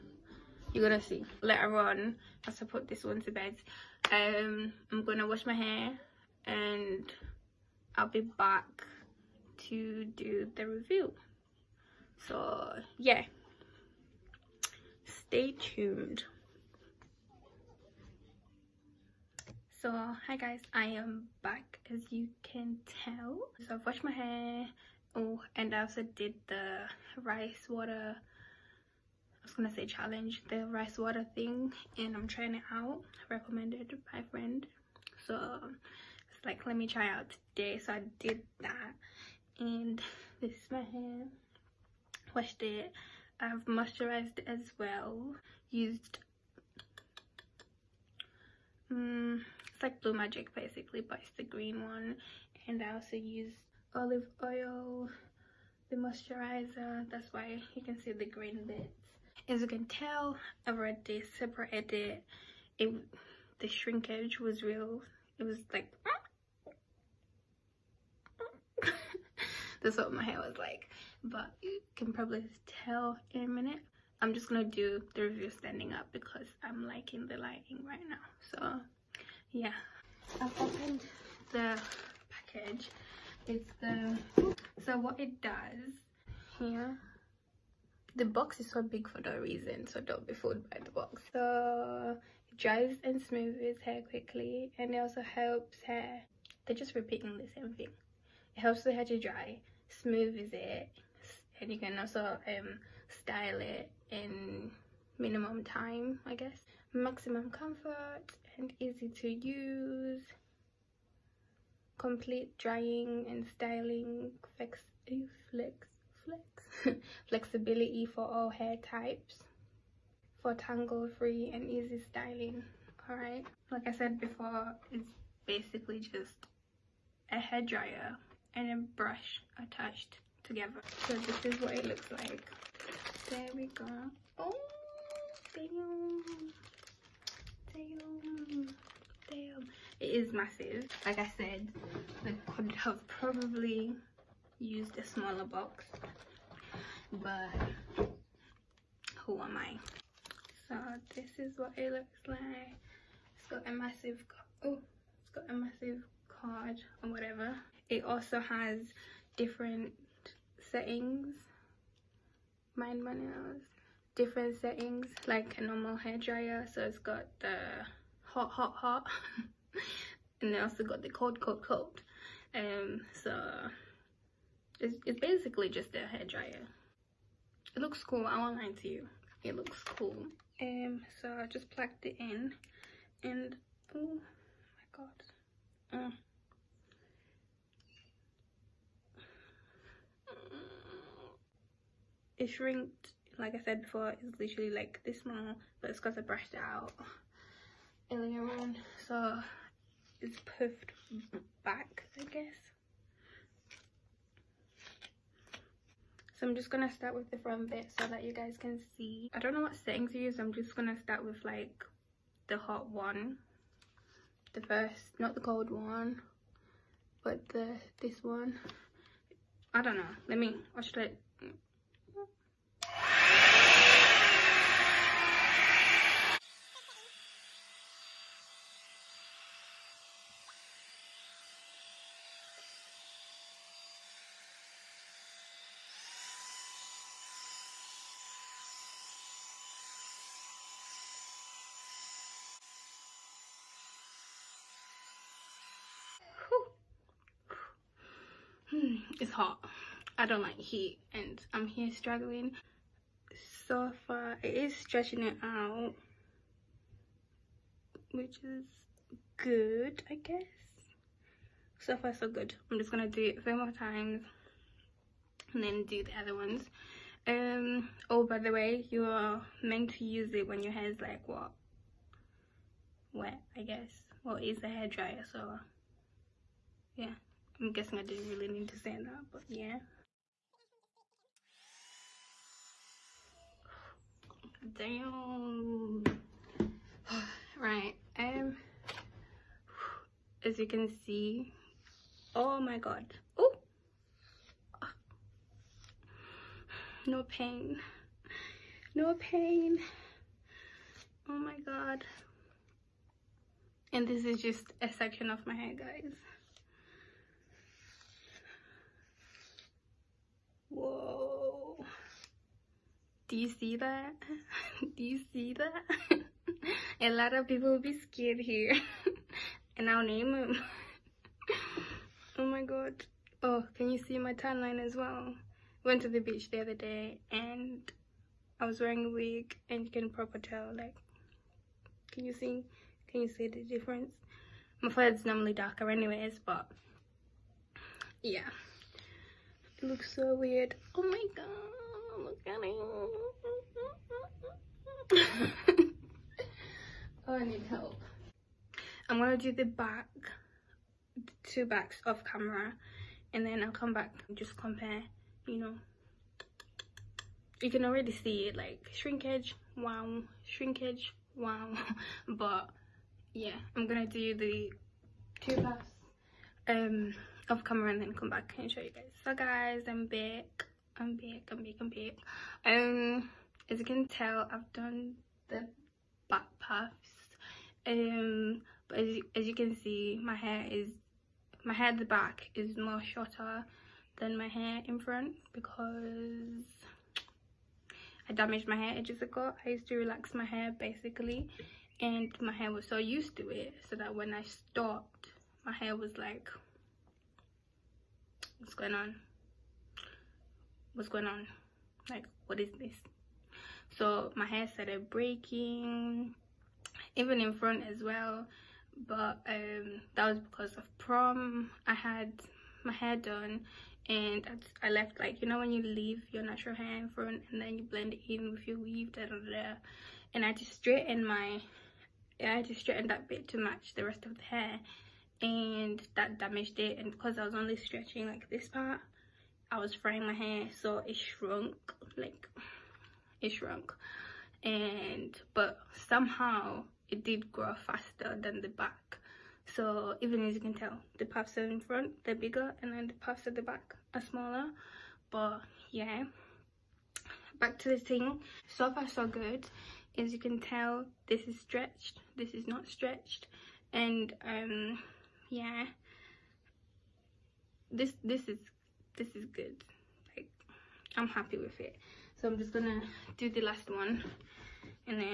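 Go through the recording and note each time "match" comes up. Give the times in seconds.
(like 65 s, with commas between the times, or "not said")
423 s.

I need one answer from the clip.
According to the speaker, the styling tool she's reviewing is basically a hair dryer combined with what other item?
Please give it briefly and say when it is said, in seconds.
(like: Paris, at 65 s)
a brush, at 128 s.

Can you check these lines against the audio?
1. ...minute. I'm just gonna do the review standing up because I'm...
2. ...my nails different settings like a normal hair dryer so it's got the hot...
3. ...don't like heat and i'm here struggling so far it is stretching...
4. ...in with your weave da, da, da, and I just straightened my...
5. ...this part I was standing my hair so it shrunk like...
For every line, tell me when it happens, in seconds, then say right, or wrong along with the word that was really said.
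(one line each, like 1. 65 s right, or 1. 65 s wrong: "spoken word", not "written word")
1. 73 s right
2. 163 s right
3. 250 s right
4. 418 s right
5. 428 s wrong: "frying", not "standing".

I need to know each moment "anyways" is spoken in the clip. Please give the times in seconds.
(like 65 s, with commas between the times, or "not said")
335 s.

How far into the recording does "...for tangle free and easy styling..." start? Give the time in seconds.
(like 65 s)
120 s.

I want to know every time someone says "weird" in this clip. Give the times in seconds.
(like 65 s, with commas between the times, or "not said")
340 s.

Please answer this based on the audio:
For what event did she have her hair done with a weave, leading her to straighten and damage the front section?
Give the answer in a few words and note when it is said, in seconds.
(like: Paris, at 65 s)
prom, at 410 s.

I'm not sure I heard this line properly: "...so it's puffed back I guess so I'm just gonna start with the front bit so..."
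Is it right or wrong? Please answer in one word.
right.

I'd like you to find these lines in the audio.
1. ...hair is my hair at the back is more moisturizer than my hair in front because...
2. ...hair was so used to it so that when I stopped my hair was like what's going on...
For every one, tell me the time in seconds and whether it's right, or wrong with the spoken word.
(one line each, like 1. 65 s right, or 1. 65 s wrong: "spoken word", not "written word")
1. 380 s wrong: "shorter", not "moisturizer"
2. 392 s right.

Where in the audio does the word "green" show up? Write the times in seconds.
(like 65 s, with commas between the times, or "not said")
51 s, 58 s.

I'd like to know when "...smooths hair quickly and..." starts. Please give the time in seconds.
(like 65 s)
93 s.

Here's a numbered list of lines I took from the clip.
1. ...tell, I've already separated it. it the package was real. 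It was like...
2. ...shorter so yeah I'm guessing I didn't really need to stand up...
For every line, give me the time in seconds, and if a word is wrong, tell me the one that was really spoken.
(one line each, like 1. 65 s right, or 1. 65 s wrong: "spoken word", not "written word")
1. 59 s wrong: "shrinkage", not "package"
2. 274 s wrong: "dryer", not "shorter".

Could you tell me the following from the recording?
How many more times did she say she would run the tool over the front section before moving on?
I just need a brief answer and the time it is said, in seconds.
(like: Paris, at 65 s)
3, at 263 s.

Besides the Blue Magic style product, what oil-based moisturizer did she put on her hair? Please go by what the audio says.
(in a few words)
olive oil.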